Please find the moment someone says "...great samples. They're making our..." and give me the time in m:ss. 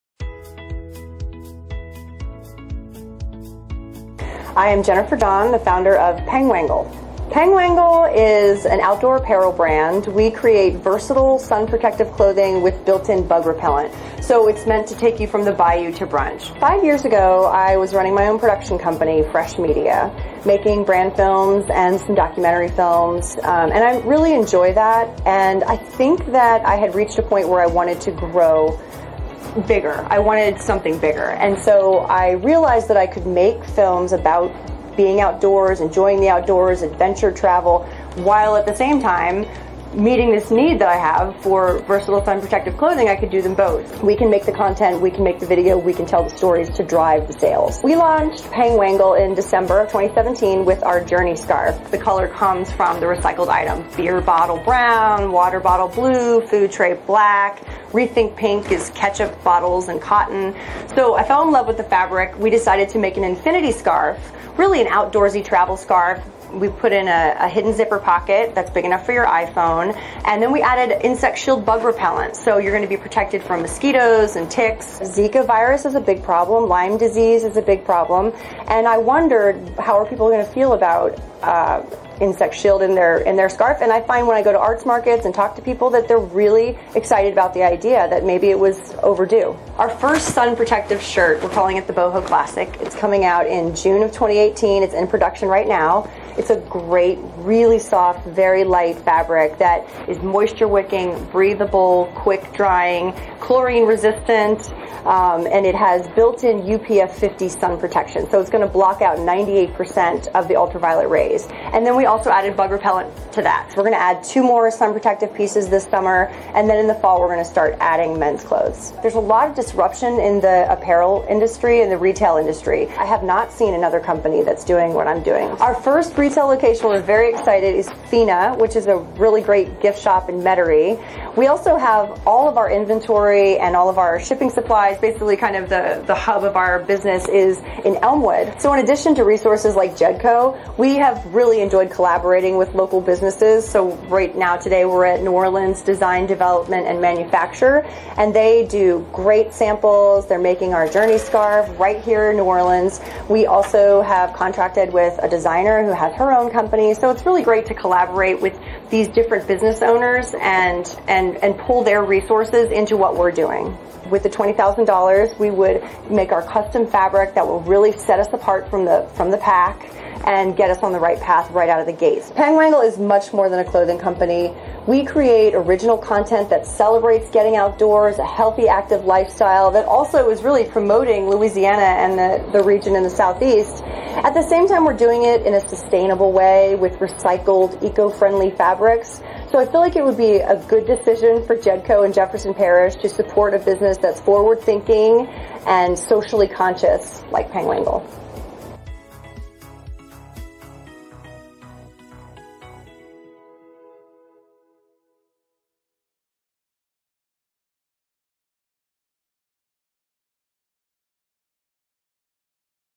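2:29.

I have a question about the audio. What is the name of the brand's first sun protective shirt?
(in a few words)
Boho Classic.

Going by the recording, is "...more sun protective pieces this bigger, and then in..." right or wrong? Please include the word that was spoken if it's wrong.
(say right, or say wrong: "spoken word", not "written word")
wrong: "summer", not "bigger".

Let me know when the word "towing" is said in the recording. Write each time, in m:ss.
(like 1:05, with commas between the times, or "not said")
not said.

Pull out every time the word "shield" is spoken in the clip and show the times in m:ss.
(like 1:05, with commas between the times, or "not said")
1:11, 1:22.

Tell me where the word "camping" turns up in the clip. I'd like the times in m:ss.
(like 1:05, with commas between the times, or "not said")
not said.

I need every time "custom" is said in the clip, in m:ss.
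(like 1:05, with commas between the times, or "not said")
2:46.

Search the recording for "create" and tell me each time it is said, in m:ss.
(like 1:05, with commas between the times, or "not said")
0:10, 2:55.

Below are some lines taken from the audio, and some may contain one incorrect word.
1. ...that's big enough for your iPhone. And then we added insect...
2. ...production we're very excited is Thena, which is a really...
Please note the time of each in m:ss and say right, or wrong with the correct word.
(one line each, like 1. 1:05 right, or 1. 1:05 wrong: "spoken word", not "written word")
1. 1:08 right
2. 2:06 wrong: "location", not "production".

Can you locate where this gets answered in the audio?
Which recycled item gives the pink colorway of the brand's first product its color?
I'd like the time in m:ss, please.
0:58.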